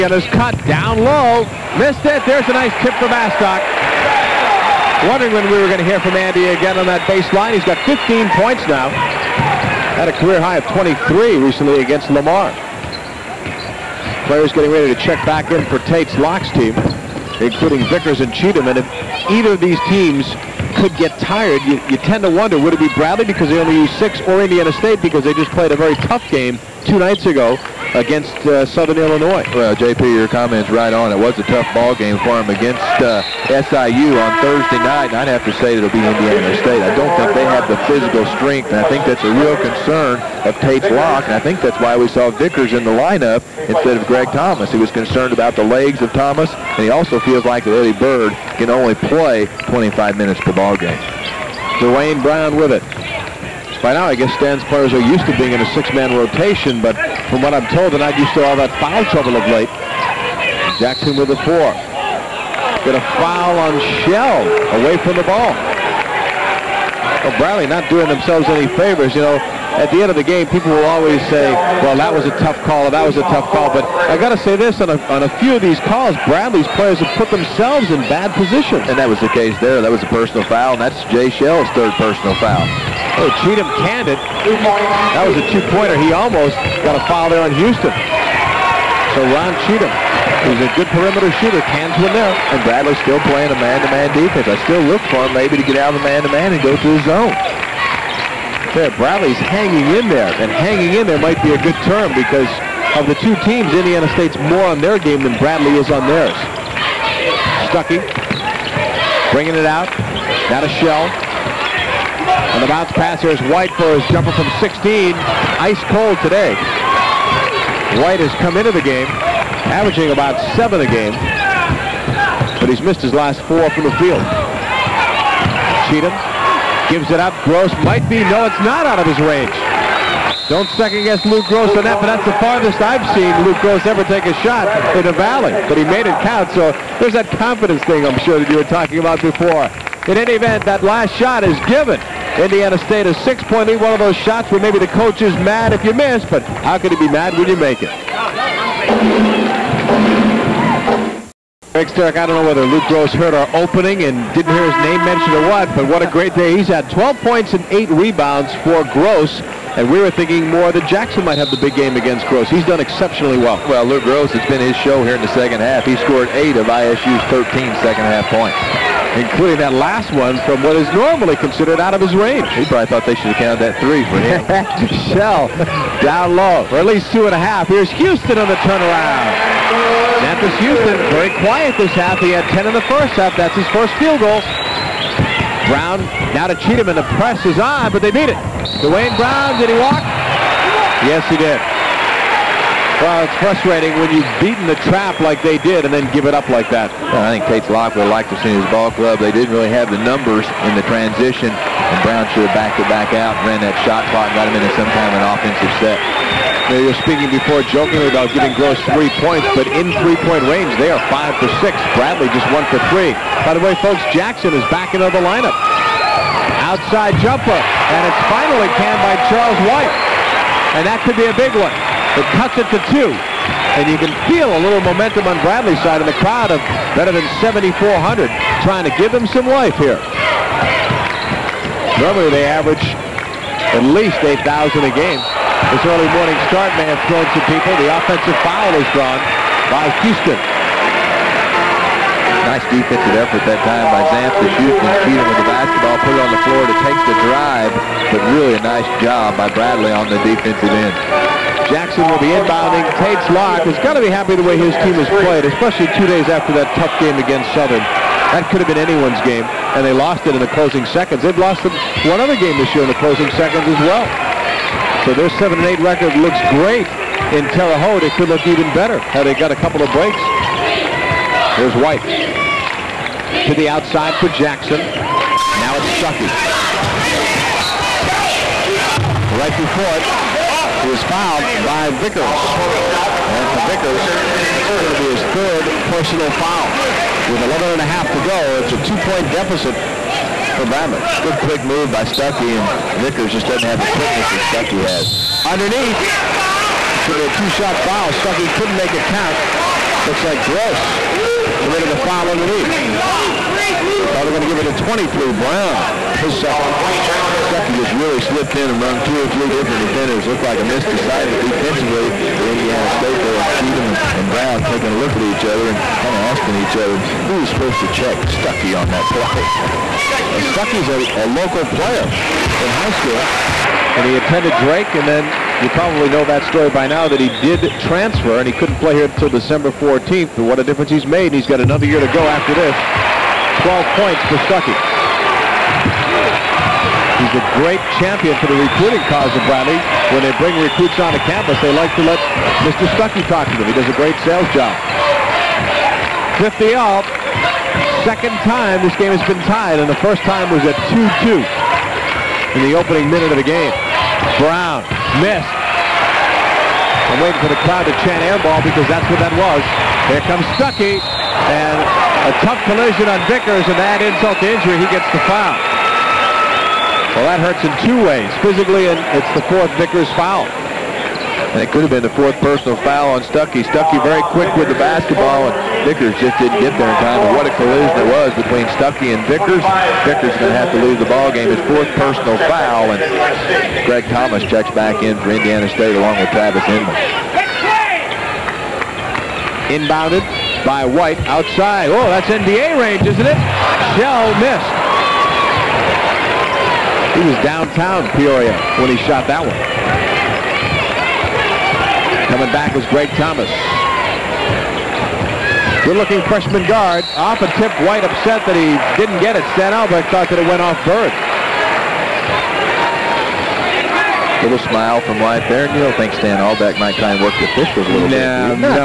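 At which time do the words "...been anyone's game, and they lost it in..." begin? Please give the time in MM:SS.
04:18.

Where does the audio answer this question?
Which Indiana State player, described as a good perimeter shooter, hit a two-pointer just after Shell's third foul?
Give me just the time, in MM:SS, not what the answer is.
01:29.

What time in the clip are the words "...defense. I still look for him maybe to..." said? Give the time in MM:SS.
01:34.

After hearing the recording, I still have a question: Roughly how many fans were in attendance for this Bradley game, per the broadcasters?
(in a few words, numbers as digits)
7,400.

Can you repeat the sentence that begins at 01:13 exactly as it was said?
But I got to say this, on a, on a few of these calls, Bradley's players have put themselves in bad positions.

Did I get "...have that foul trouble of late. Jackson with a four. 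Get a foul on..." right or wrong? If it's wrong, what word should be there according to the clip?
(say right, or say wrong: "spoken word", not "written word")
right.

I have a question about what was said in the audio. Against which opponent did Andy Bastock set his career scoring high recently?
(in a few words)
Lamar.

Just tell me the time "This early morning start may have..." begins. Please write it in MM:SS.
03:55.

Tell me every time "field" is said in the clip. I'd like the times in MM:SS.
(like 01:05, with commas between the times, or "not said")
02:03, 03:04.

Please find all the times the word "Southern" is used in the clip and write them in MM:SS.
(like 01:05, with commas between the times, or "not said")
00:28, 04:17.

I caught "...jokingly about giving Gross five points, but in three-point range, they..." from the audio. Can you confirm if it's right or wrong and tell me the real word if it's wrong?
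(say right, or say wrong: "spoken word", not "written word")
wrong: "three", not "five".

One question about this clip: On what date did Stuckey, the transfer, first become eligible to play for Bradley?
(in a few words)
December 14.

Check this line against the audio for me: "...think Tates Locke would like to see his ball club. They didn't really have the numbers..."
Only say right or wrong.
right.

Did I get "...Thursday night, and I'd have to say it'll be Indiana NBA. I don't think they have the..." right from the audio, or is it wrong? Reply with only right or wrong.
wrong.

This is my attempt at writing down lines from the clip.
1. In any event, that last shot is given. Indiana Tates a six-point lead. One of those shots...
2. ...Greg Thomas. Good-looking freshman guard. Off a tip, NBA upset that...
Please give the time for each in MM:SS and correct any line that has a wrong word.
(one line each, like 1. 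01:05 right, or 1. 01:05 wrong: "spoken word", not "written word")
1. 02:20 wrong: "State", not "Tates"
2. 06:42 wrong: "White", not "NBA".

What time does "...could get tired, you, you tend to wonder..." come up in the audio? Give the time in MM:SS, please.
00:20.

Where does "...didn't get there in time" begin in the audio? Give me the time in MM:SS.
06:16.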